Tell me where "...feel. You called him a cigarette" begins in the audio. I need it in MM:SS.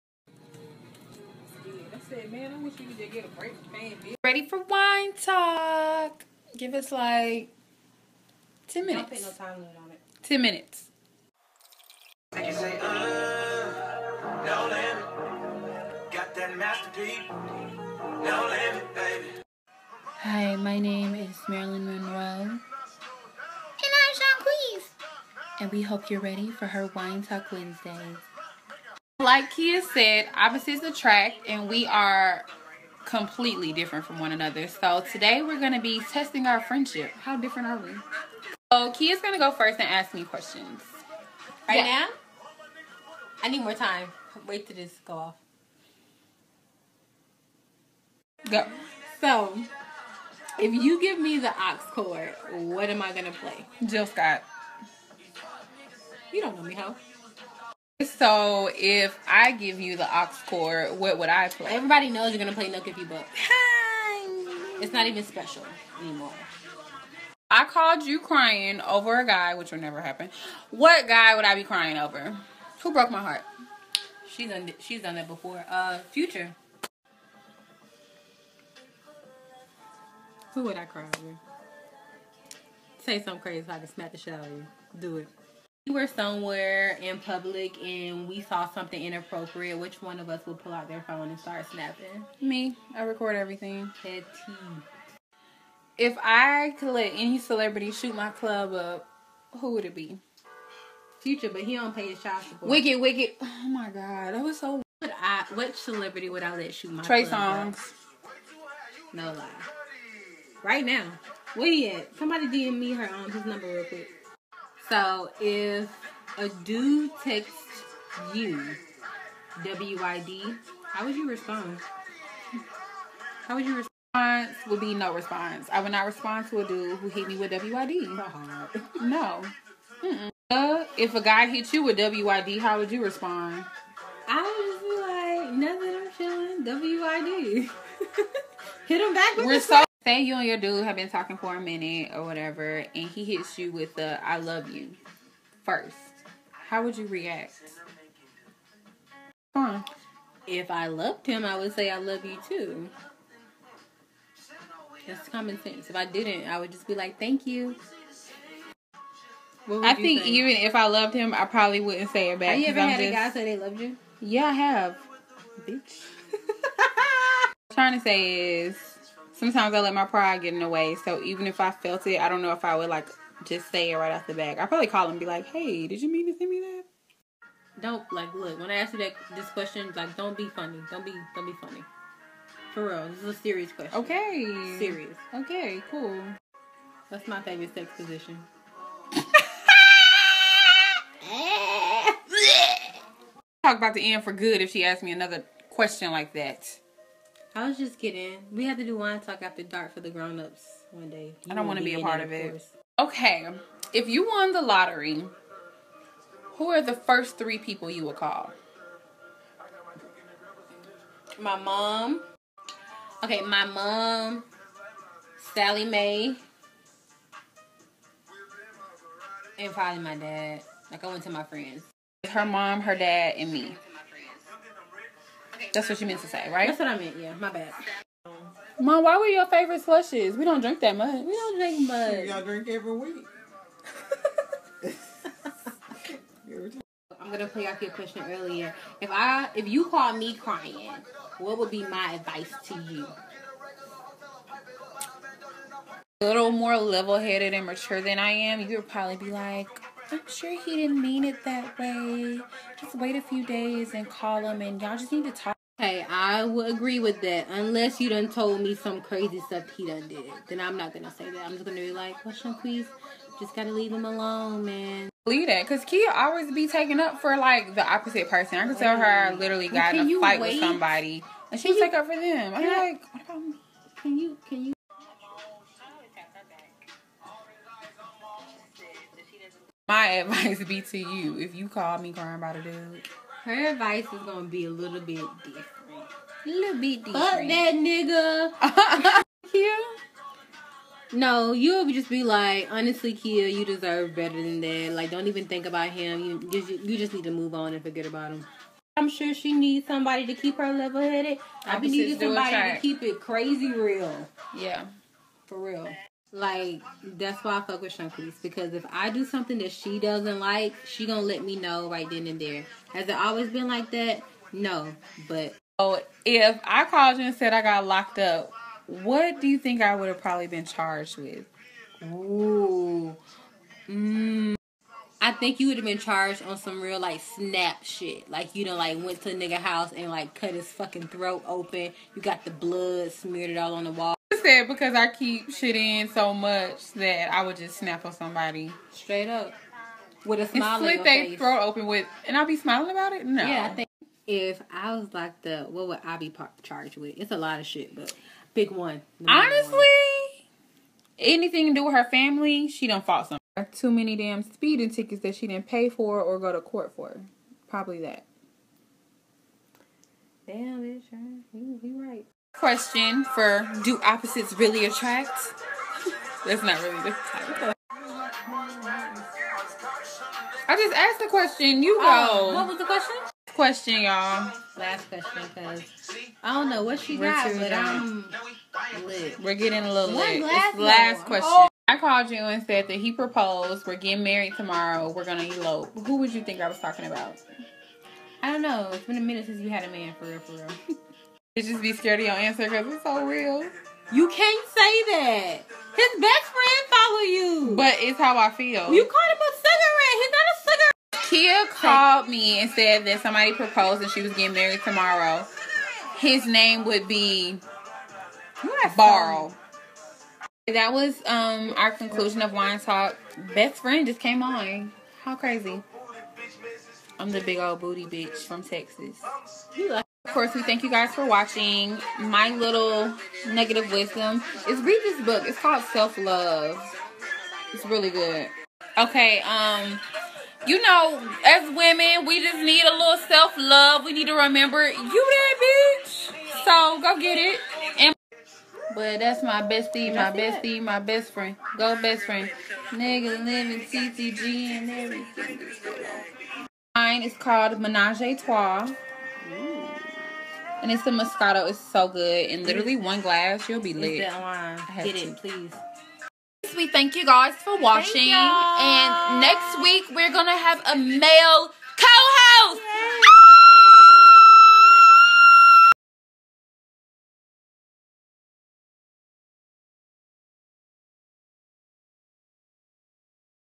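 06:38.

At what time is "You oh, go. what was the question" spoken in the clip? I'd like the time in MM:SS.
06:11.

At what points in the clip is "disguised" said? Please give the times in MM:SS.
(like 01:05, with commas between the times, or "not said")
not said.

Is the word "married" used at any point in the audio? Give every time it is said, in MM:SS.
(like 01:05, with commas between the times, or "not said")
06:24, 06:44.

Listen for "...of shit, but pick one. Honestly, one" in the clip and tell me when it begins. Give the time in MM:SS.
05:47.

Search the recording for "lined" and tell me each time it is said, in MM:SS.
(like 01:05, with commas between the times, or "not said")
not said.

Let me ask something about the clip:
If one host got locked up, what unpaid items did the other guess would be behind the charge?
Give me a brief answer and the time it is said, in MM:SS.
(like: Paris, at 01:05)
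Speeding tickets, at 05:54.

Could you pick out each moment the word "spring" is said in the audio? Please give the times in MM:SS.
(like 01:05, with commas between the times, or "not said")
not said.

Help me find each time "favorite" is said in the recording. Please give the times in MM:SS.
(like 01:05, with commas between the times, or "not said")
03:07, 03:49.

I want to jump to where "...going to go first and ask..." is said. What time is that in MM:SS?
00:39.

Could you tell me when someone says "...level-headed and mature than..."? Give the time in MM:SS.
04:06.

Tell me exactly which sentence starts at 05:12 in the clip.
Has it always been like that?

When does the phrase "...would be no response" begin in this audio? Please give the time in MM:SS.
02:04.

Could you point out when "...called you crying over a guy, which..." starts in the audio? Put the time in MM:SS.
01:07.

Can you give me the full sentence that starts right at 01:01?
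Everybody knows you're gonna play Nook if you book.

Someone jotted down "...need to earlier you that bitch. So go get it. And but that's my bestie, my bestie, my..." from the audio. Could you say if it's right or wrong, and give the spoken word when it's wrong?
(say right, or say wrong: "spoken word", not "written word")
wrong: "remember", not "earlier".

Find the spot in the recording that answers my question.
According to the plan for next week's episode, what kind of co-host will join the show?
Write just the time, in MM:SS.
07:40.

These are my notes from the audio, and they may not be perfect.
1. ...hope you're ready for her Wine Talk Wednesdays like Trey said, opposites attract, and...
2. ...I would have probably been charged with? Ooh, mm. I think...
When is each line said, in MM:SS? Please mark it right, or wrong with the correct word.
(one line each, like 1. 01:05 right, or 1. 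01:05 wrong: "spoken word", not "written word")
1. 00:25 wrong: "Kia", not "Trey"
2. 05:19 right.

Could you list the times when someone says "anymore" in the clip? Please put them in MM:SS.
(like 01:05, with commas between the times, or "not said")
01:06.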